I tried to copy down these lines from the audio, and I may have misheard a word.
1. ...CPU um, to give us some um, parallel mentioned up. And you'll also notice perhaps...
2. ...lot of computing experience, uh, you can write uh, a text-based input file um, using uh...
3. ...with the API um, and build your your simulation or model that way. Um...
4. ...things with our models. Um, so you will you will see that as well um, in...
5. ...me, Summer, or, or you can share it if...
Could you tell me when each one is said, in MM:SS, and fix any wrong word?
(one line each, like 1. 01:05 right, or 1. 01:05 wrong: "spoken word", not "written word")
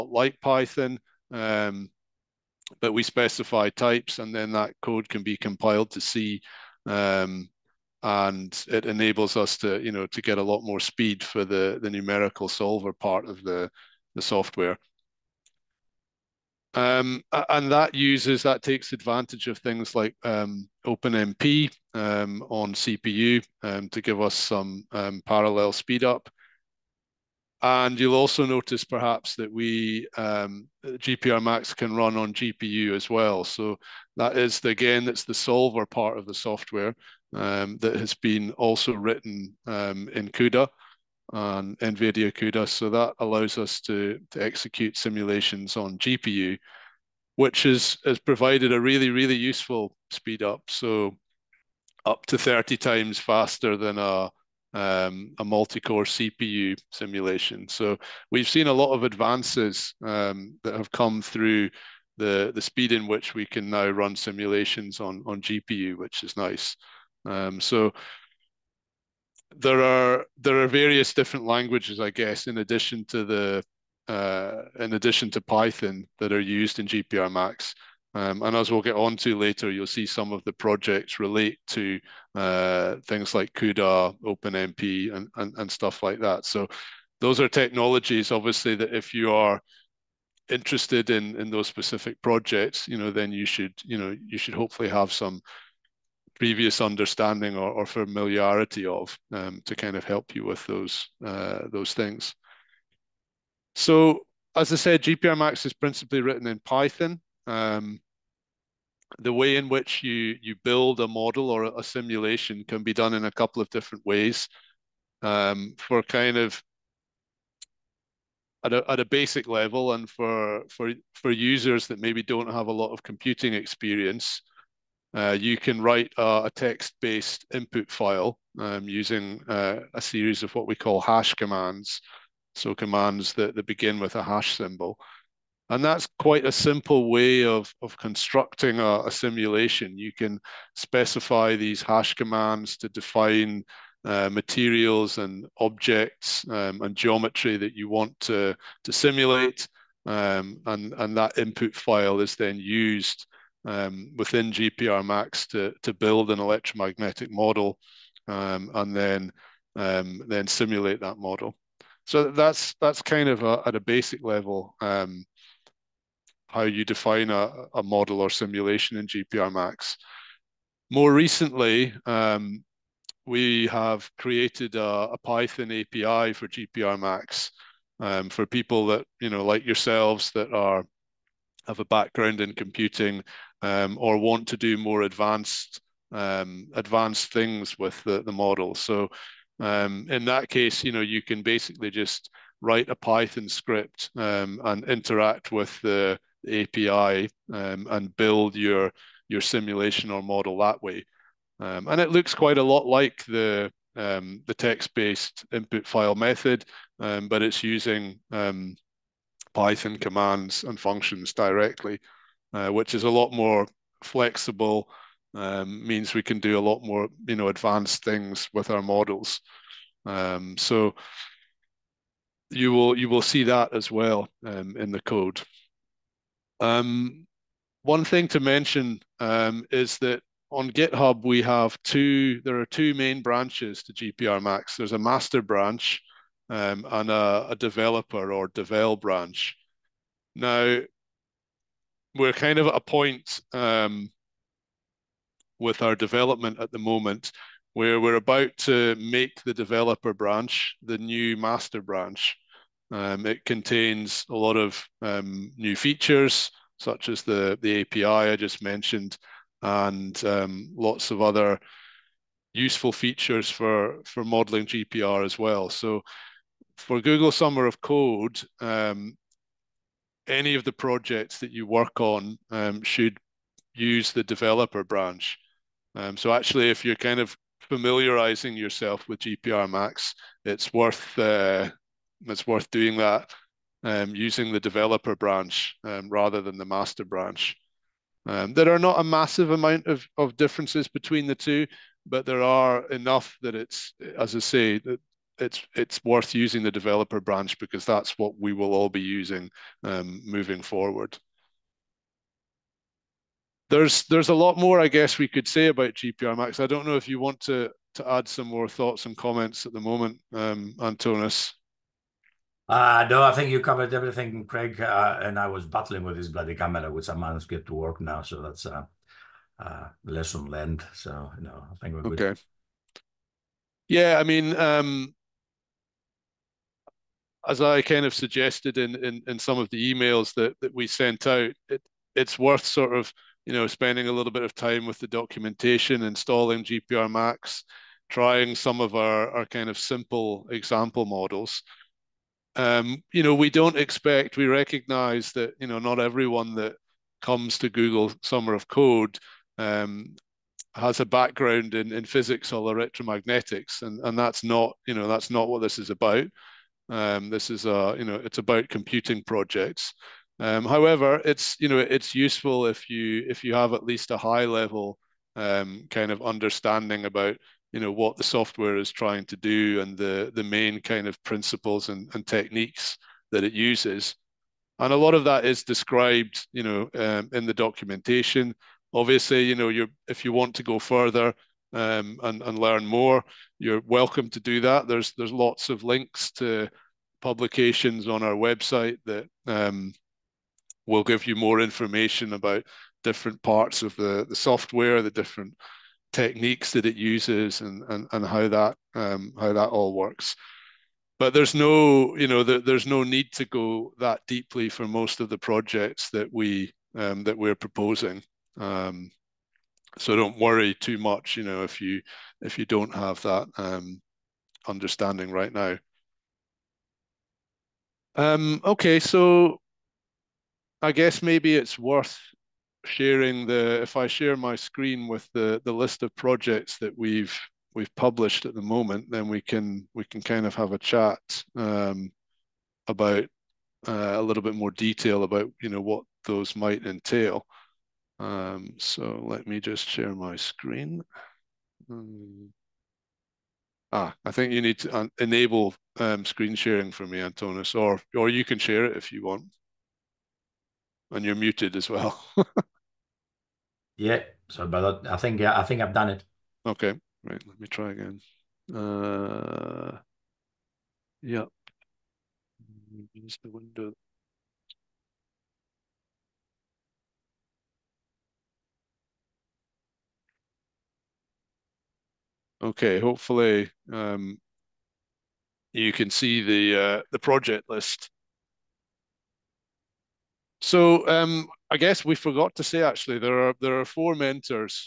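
1. 00:22 wrong: "speed", not "mentioned"
2. 02:02 right
3. 03:15 right
4. 03:38 right
5. 07:27 wrong: "Antonis", not "Summer".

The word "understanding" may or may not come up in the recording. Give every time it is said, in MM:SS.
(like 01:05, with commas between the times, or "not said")
01:36, 06:06, 06:54.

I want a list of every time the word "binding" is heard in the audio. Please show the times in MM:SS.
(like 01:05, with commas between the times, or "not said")
not said.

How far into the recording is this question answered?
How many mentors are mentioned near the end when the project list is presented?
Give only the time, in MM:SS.
08:03.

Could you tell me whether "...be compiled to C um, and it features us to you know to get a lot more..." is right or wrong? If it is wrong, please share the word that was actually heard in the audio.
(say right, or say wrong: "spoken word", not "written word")
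wrong: "enables", not "features".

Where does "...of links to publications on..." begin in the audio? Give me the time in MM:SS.
06:25.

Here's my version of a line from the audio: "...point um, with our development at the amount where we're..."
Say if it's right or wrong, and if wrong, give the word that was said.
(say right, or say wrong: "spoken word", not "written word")
wrong: "moment", not "amount".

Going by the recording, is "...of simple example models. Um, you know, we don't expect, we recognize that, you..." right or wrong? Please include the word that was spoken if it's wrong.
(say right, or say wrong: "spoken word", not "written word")
right.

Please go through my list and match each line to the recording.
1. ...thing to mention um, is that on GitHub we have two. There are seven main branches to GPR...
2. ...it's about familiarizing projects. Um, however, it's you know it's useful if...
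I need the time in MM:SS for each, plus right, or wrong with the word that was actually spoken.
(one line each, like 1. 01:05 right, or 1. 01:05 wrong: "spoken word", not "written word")
1. 03:48 wrong: "two", not "seven"
2. 05:58 wrong: "computing", not "familiarizing".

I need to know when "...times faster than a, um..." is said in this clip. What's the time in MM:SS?
00:52.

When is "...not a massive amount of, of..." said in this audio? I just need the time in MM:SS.
04:48.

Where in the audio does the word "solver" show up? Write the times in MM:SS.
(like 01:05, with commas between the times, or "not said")
00:12, 00:35.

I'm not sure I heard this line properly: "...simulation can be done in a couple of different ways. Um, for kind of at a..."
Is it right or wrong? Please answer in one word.
right.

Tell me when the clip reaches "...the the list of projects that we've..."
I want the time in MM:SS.
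07:05.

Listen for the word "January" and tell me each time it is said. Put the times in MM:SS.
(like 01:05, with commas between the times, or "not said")
not said.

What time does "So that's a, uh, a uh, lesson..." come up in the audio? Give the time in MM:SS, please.
05:18.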